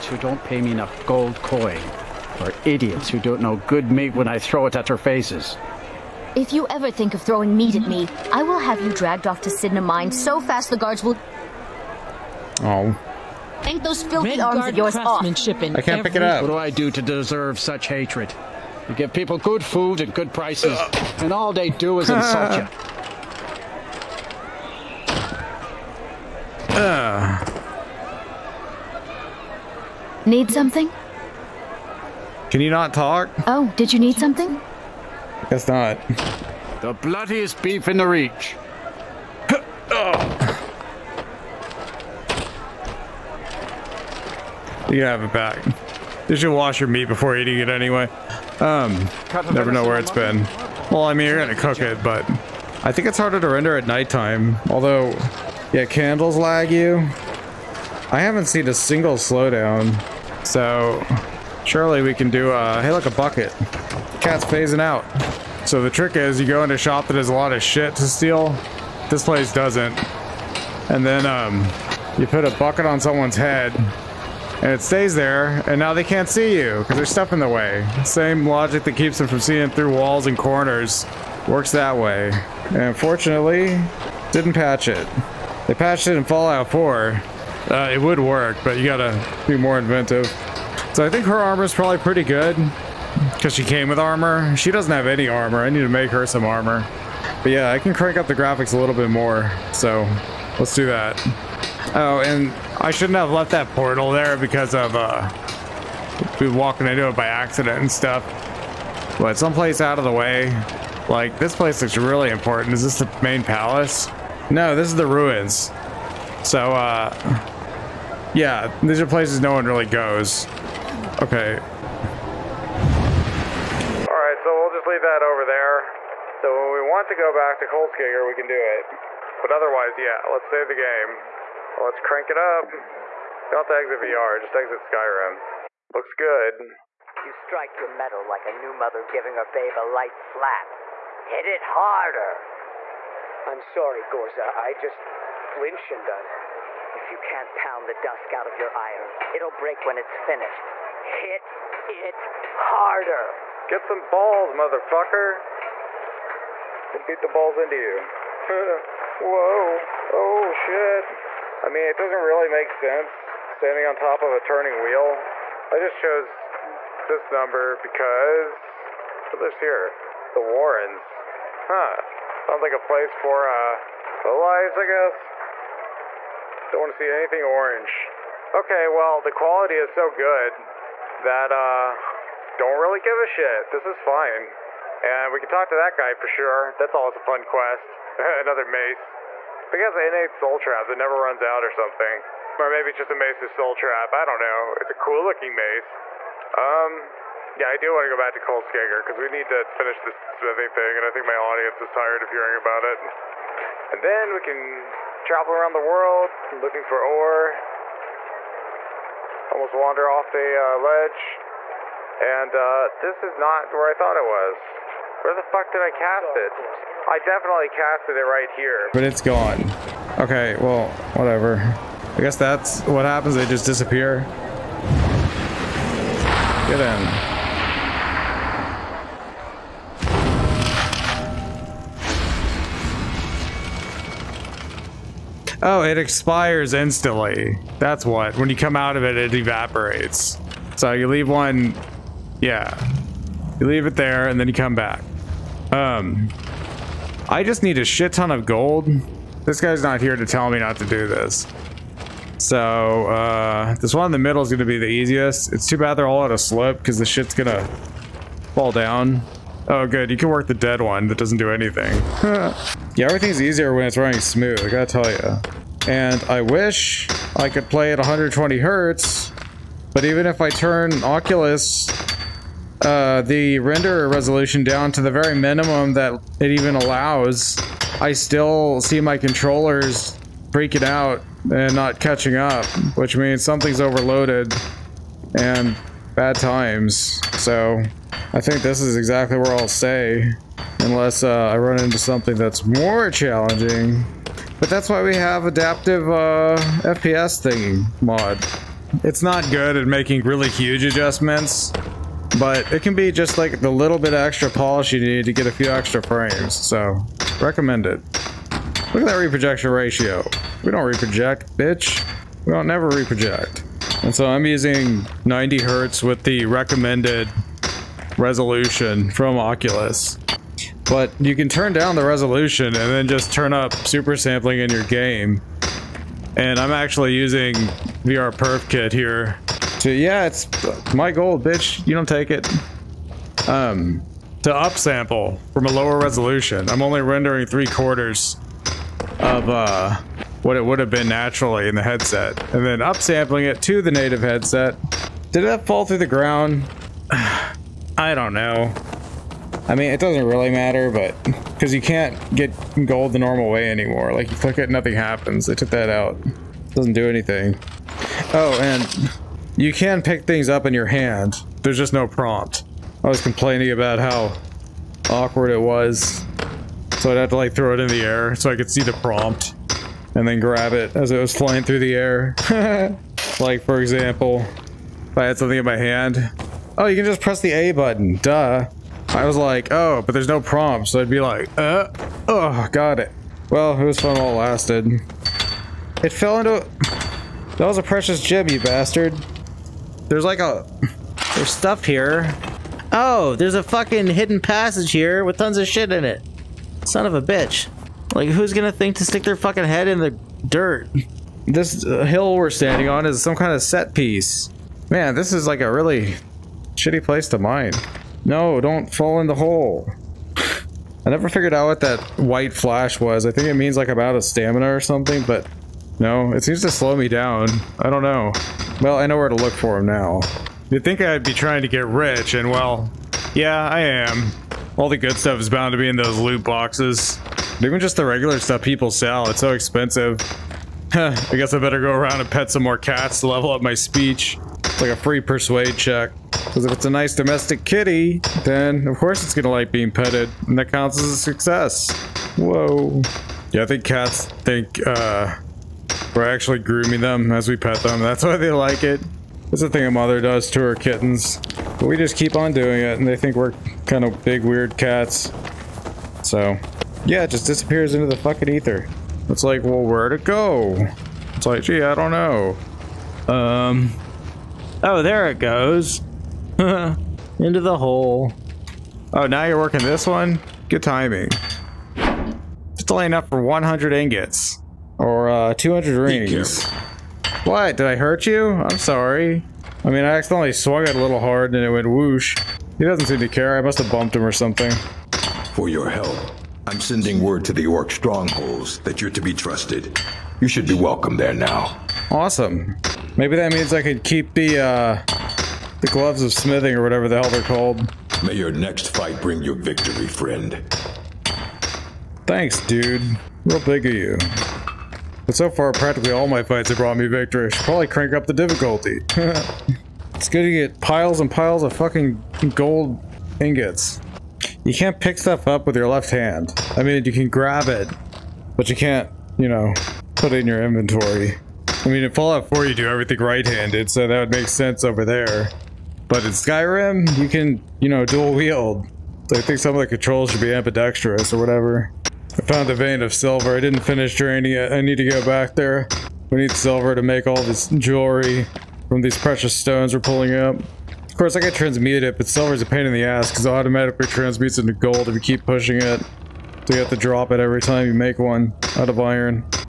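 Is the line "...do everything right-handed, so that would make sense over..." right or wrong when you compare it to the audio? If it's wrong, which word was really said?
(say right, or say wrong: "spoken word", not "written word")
right.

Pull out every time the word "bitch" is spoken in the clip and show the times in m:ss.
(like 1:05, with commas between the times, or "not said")
5:11, 5:31, 6:37.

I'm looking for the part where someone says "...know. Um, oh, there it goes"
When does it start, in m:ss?
7:42.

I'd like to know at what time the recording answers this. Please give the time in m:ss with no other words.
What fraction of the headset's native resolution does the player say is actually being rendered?
5:37.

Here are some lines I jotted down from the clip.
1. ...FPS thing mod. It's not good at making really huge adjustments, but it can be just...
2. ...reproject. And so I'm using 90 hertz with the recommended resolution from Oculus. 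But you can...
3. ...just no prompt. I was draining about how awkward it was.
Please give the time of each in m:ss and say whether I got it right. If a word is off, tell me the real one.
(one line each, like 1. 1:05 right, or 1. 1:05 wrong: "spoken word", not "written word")
1. 4:56 right
2. 5:12 right
3. 6:01 wrong: "complaining", not "draining".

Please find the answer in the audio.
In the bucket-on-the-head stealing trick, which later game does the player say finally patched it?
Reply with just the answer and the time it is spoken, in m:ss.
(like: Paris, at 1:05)
Fallout 4, at 1:25.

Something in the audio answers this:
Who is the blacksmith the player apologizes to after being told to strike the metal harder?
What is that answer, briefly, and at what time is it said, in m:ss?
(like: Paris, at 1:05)
Ghorza, at 2:24.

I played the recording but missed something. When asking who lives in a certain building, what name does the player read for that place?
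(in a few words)
The Warrens.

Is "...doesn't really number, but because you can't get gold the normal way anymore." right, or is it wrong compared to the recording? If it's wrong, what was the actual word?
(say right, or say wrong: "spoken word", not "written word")
wrong: "matter", not "number".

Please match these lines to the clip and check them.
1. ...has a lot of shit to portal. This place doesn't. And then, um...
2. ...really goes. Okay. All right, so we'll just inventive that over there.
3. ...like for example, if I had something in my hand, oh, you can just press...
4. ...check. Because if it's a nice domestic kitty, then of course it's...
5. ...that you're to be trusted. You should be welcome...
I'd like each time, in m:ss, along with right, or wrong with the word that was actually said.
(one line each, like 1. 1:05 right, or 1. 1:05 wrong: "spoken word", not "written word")
1. 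1:07 wrong: "steal", not "portal"
2. 1:59 wrong: "leave", not "inventive"
3. 6:13 right
4. 7:15 right
5. 8:08 right.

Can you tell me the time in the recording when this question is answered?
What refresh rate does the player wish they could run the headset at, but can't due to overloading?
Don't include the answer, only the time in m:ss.
4:27.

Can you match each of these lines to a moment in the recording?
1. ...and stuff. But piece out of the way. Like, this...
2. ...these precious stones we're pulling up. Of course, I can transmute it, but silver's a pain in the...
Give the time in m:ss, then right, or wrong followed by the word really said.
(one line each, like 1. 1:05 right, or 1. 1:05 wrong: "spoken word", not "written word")
1. 1:47 wrong: "someplace", not "piece"
2. 8:59 right.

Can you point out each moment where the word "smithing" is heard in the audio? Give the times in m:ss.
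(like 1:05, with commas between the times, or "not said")
3:20, 8:16.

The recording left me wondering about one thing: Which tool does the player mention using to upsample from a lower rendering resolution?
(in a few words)
VR Perf Kit.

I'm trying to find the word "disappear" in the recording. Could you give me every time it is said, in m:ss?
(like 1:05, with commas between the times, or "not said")
3:43, 7:37.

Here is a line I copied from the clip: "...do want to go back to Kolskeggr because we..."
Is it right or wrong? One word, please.
right.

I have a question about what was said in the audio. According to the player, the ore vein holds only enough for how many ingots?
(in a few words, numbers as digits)
100.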